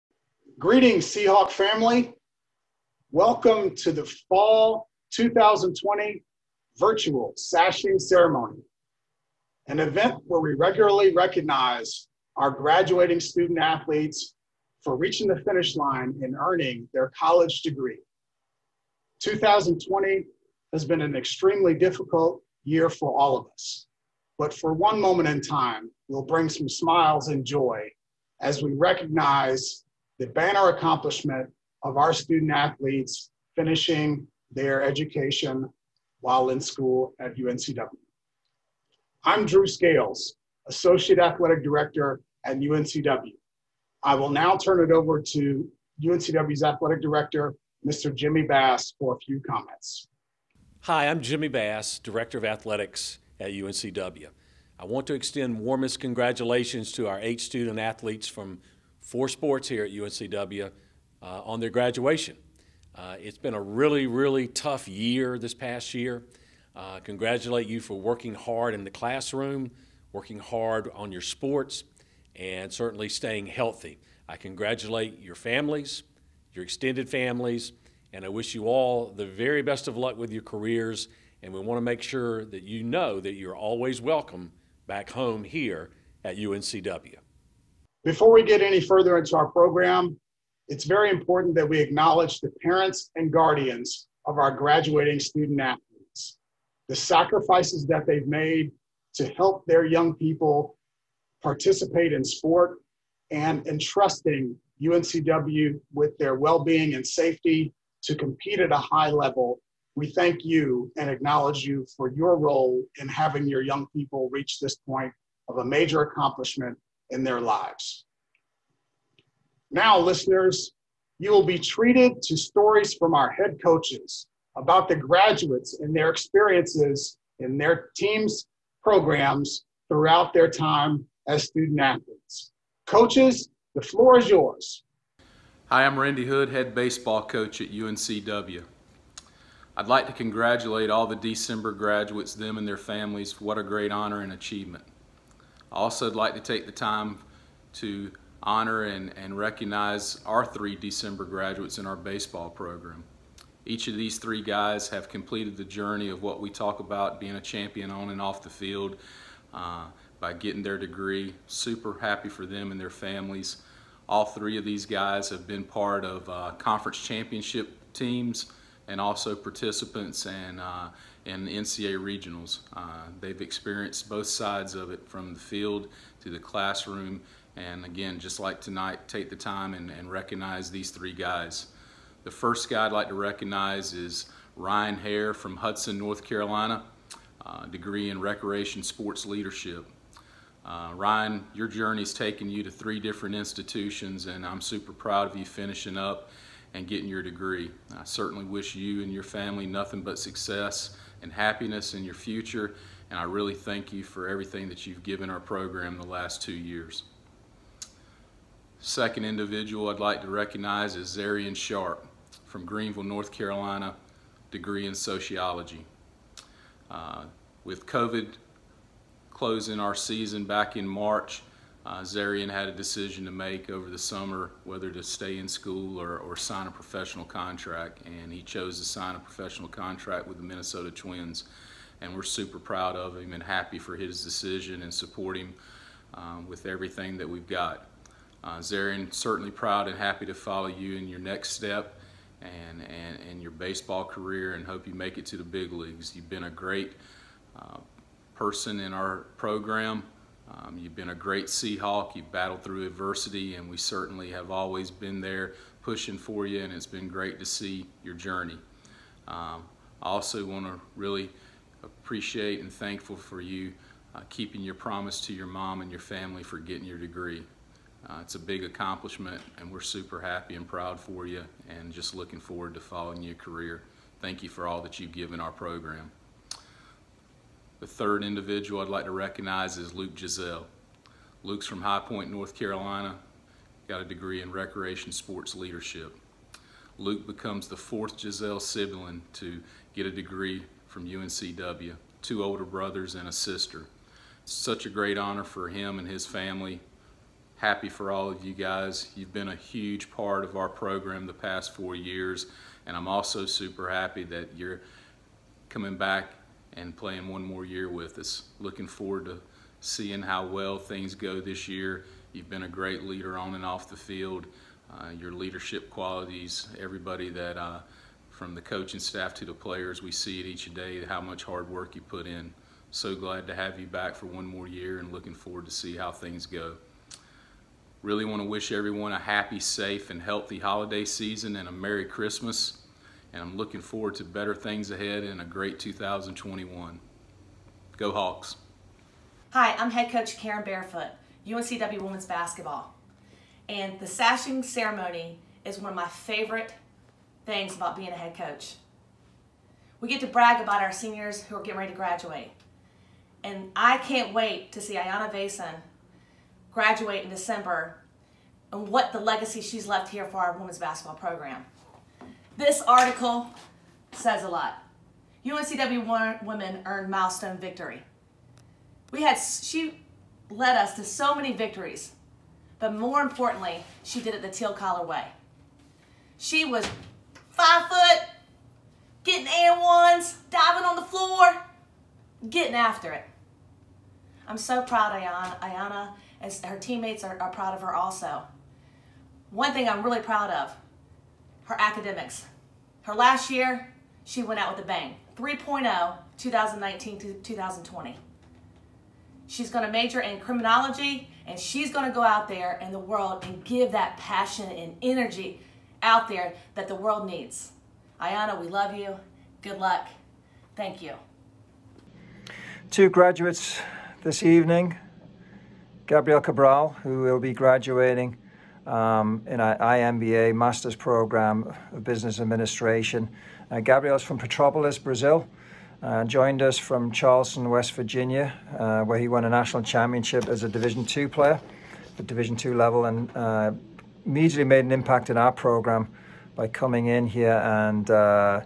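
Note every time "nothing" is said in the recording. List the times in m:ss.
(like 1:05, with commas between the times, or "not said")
3:19.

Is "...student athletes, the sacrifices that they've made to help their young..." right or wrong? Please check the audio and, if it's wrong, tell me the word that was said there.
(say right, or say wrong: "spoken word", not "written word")
right.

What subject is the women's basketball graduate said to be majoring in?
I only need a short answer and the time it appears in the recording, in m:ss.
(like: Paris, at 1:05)
Criminology, at 6:40.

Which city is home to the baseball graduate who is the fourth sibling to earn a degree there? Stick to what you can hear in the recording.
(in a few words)
High Point, North Carolina.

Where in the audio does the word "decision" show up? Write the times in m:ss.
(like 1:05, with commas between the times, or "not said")
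3:42, 3:54.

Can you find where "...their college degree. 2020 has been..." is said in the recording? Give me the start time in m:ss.
0:16.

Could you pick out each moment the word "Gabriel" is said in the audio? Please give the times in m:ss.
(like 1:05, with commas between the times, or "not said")
6:56, 7:03.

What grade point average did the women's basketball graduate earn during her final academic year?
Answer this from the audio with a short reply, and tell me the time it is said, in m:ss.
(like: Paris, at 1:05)
3.0, at 6:35.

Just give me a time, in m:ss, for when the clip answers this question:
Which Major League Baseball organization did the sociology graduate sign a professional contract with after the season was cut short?
3:50.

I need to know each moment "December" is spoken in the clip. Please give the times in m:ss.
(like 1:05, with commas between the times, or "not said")
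2:21, 2:30, 5:57.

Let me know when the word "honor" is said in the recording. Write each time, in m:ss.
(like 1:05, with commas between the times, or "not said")
2:23, 2:28, 4:55.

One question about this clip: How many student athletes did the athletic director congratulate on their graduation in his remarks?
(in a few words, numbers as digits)
8.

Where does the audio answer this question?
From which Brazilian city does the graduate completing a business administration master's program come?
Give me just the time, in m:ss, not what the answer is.
7:04.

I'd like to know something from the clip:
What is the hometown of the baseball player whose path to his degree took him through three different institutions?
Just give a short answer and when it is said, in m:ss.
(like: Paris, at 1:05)
Hudson, North Carolina, at 3:05.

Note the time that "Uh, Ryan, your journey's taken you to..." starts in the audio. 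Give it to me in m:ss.
3:10.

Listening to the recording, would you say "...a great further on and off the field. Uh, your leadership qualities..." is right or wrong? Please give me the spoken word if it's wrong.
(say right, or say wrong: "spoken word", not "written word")
wrong: "leader", not "further".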